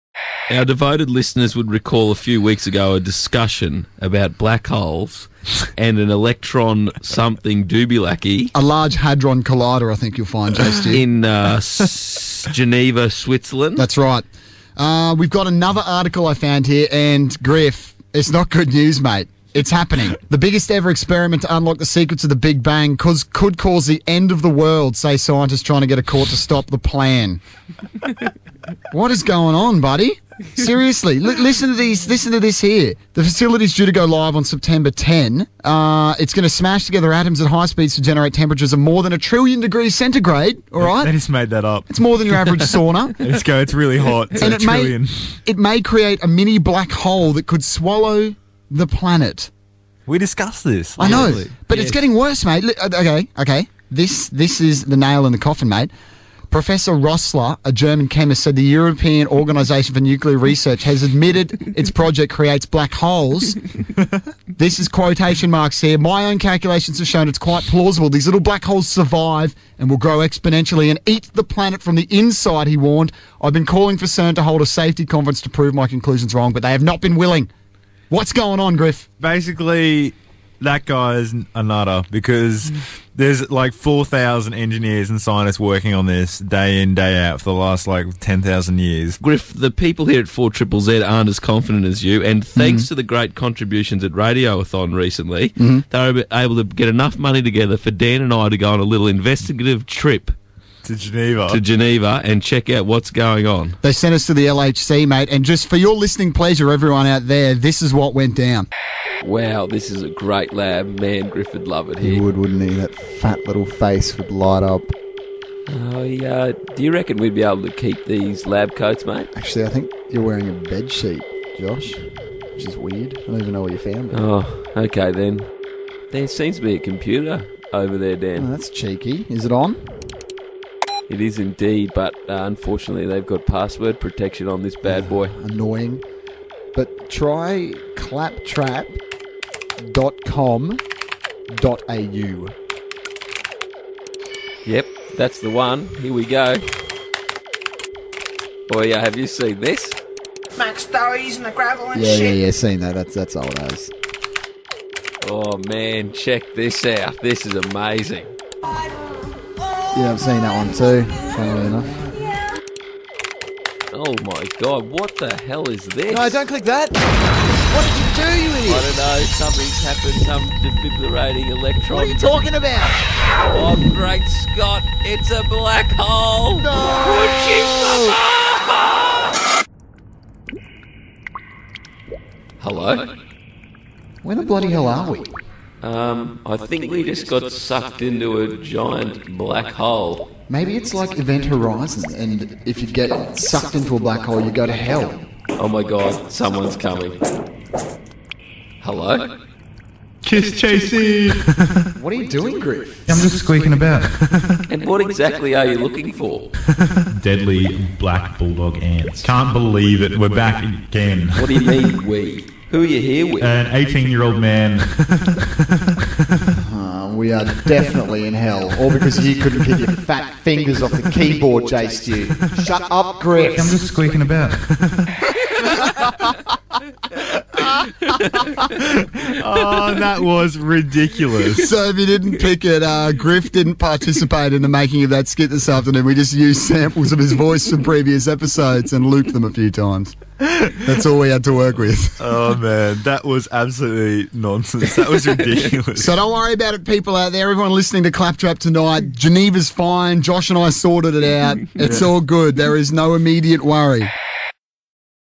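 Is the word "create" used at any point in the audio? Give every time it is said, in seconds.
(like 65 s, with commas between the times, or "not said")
45 s, 62 s.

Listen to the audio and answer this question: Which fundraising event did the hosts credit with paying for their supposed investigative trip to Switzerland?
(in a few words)
Radioathon.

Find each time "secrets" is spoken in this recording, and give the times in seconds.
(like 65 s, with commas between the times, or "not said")
21 s.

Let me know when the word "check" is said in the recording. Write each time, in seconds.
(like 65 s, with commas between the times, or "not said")
102 s, 156 s.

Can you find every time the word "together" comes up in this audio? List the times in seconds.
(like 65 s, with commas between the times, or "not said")
36 s, 97 s.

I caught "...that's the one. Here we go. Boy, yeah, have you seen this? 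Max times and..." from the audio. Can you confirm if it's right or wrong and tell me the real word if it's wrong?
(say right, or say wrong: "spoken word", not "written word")
wrong: "stories", not "times".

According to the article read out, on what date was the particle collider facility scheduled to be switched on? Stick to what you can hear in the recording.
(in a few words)
September 10.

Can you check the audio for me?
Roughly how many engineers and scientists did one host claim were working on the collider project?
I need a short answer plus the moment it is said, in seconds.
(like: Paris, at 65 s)
4,000, at 83 s.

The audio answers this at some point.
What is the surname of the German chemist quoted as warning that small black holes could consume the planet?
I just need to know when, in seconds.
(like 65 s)
56 s.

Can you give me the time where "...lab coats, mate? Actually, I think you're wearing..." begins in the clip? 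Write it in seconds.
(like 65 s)
118 s.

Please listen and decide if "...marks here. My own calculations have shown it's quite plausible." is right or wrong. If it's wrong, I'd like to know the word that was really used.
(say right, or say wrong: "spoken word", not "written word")
right.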